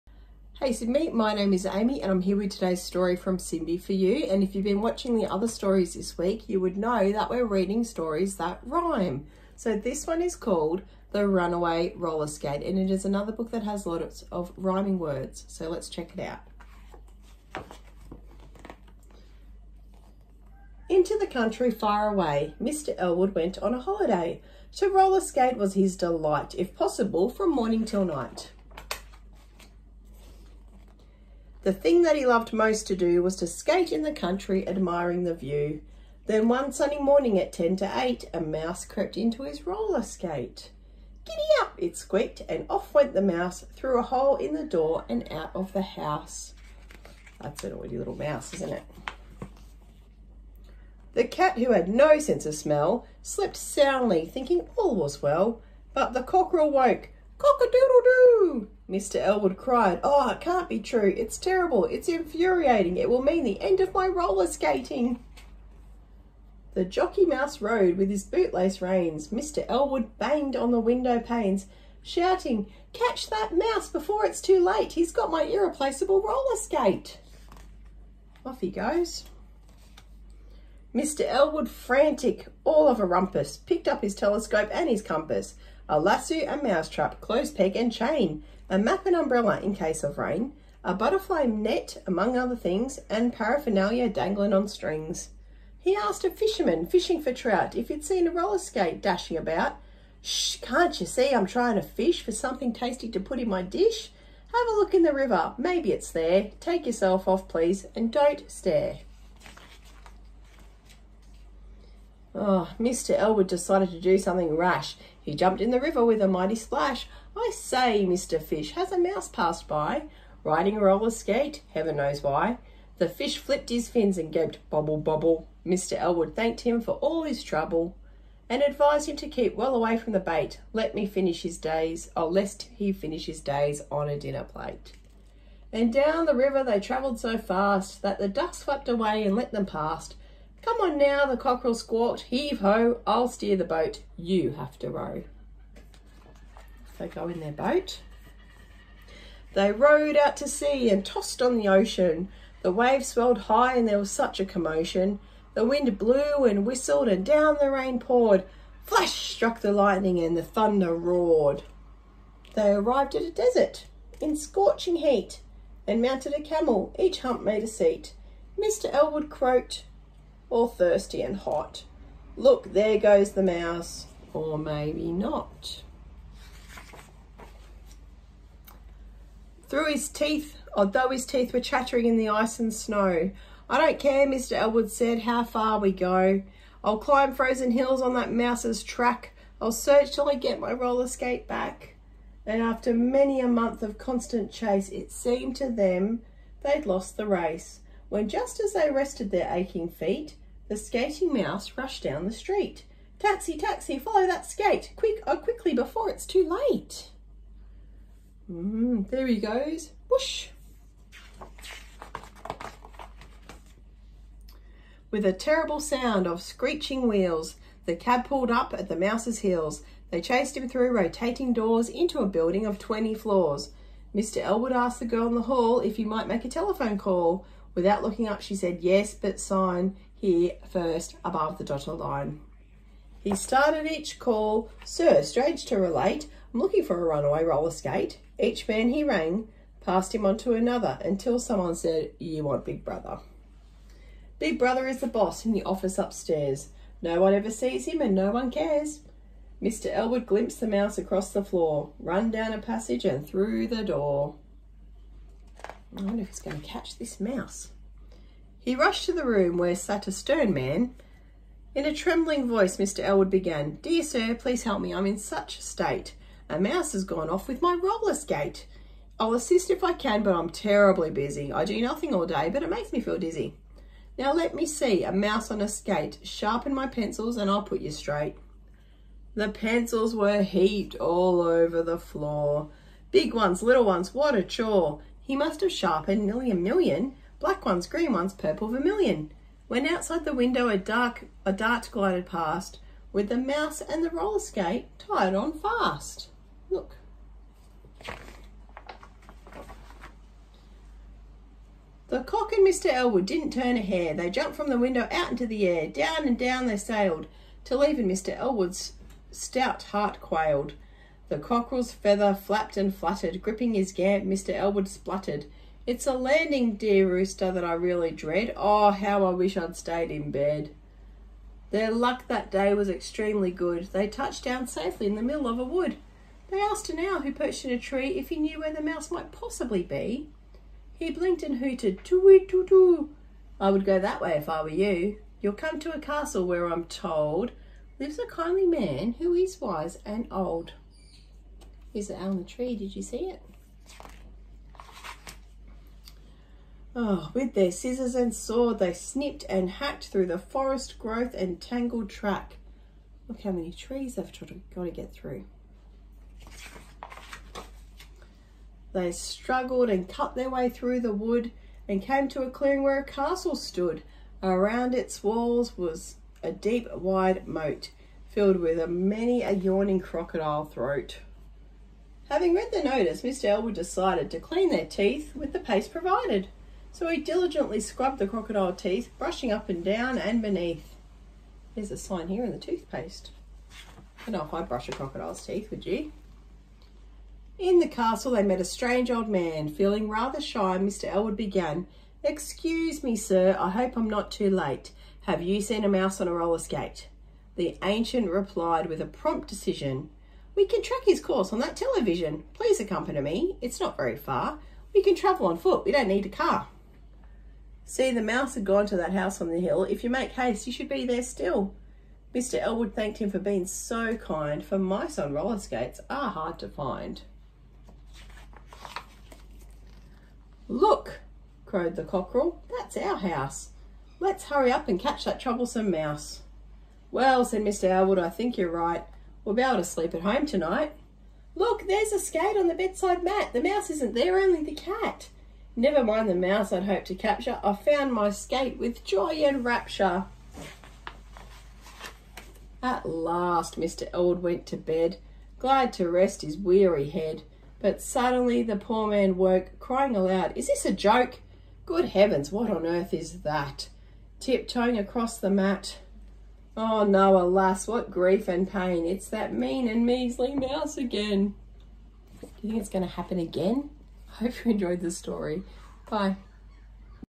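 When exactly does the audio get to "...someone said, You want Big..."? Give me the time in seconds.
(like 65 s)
241 s.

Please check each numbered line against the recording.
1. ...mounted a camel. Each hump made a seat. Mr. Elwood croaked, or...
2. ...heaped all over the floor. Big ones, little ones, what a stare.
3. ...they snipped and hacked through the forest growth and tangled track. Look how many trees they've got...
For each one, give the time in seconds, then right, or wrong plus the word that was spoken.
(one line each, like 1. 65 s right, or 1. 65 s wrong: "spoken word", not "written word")
1. 166 s right
2. 280 s wrong: "chore", not "stare"
3. 348 s right.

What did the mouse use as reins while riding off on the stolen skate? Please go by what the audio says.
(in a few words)
Bootlace reins.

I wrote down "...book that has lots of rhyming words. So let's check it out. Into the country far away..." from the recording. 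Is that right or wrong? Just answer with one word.
right.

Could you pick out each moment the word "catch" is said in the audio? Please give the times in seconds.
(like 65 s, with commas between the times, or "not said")
72 s, 256 s, 424 s.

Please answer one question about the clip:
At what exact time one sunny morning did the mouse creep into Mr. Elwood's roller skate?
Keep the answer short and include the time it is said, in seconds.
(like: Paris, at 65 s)
10 to 8, at 37 s.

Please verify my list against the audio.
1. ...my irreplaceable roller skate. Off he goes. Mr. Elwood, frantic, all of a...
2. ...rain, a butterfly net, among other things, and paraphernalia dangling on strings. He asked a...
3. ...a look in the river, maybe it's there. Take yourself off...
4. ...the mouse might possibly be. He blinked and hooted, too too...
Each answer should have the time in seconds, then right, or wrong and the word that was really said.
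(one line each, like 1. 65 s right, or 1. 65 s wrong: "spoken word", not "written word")
1. 75 s right
2. 90 s right
3. 104 s right
4. 328 s right.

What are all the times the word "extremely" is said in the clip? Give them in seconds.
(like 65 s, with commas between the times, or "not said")
322 s.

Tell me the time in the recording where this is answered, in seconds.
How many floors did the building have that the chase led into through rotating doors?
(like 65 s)
222 s.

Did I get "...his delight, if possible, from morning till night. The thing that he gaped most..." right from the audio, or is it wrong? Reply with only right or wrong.
wrong.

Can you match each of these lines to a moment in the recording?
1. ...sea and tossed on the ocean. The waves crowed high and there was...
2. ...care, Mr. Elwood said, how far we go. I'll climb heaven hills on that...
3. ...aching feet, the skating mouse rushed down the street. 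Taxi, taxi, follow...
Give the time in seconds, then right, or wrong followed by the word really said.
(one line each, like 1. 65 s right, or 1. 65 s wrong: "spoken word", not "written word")
1. 150 s wrong: "swelled", not "crowed"
2. 183 s wrong: "frozen", not "heaven"
3. 199 s right.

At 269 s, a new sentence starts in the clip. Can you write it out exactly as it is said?
I'll assist if I can, but I'm terribly busy.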